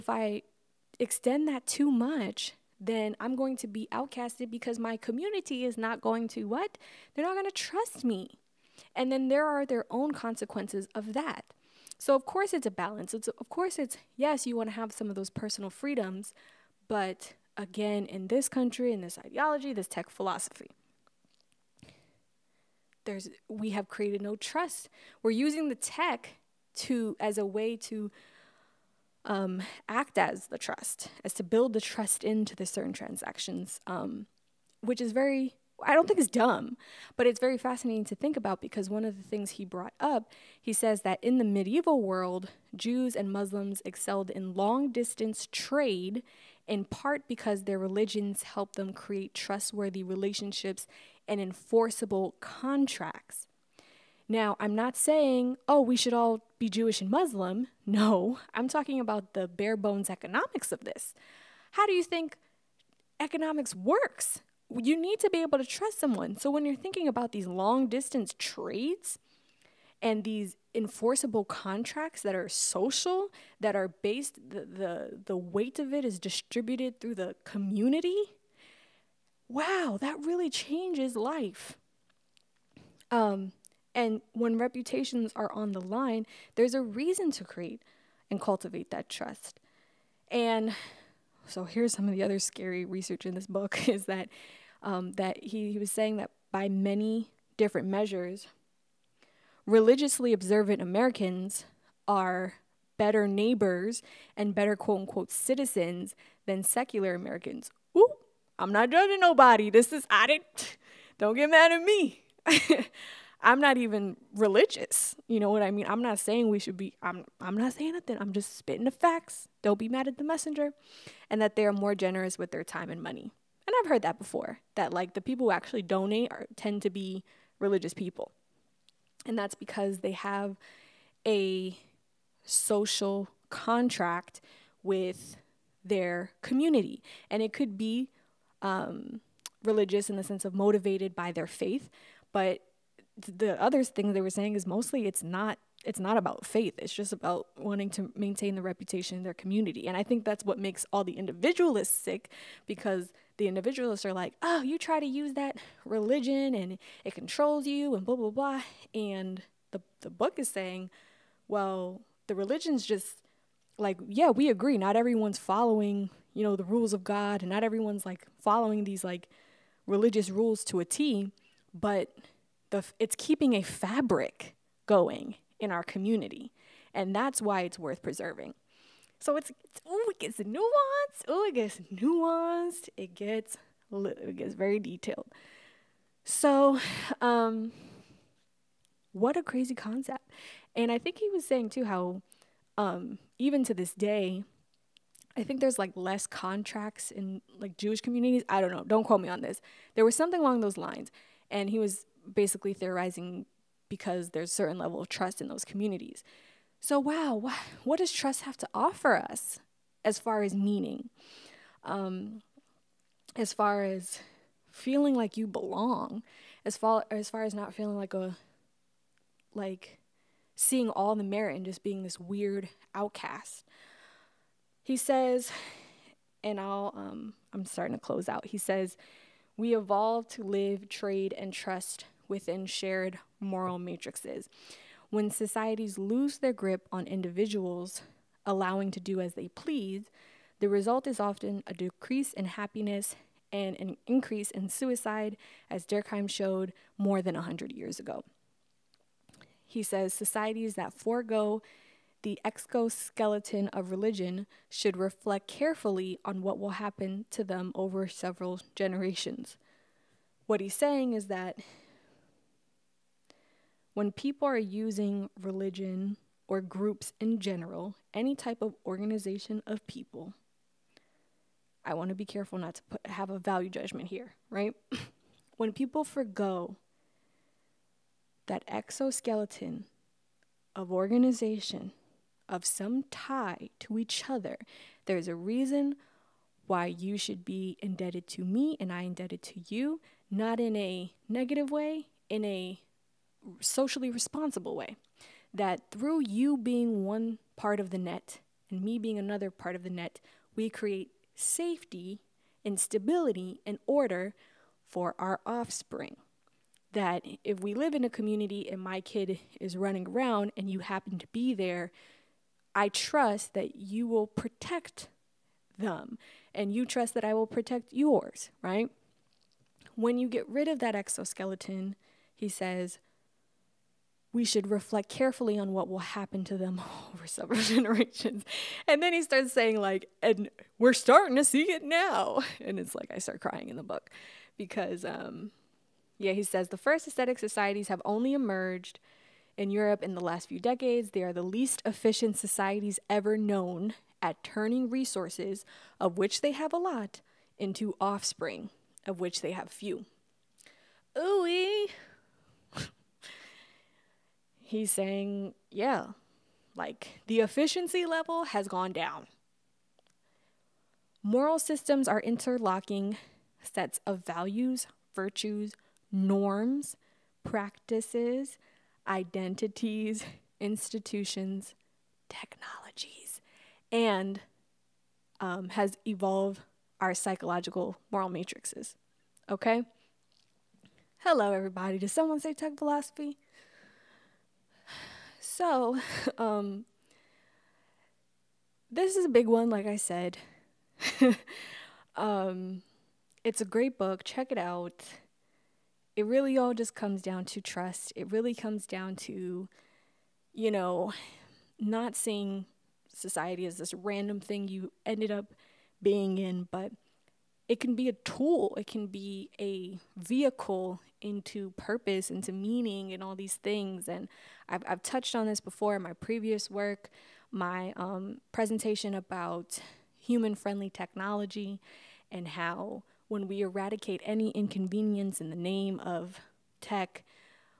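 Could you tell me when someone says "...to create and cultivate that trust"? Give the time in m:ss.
1:27.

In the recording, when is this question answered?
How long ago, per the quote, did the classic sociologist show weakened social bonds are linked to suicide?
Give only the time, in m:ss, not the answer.
4:06.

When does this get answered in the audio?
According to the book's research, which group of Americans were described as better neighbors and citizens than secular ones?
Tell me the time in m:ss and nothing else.
1:39.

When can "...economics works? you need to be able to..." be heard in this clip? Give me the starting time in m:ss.
1:03.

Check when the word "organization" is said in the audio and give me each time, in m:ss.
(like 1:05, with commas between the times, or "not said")
4:28, 4:40.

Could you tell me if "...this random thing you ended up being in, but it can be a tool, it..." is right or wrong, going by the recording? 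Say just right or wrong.
right.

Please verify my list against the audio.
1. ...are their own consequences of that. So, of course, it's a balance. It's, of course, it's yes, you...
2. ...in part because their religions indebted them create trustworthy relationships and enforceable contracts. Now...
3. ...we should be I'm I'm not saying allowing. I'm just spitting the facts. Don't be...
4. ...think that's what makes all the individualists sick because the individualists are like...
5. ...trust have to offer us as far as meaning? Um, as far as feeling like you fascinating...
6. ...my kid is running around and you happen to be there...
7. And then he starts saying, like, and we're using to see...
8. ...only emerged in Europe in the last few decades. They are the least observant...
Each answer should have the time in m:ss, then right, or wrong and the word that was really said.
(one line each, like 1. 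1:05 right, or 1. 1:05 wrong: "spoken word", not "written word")
1. 0:09 right
2. 0:46 wrong: "helped", not "indebted"
3. 1:56 wrong: "nothing", not "allowing"
4. 2:30 right
5. 3:28 wrong: "belong", not "fascinating"
6. 5:08 right
7. 5:28 wrong: "starting", not "using"
8. 5:38 wrong: "efficient", not "observant".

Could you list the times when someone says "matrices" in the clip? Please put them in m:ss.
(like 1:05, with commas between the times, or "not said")
3:53, 6:18.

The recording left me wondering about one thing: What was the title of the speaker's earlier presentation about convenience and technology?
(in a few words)
human friendly technology.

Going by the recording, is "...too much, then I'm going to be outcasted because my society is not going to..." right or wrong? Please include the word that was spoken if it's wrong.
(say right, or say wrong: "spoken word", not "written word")
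wrong: "community", not "society".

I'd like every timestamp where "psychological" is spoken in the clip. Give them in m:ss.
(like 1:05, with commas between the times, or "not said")
6:17.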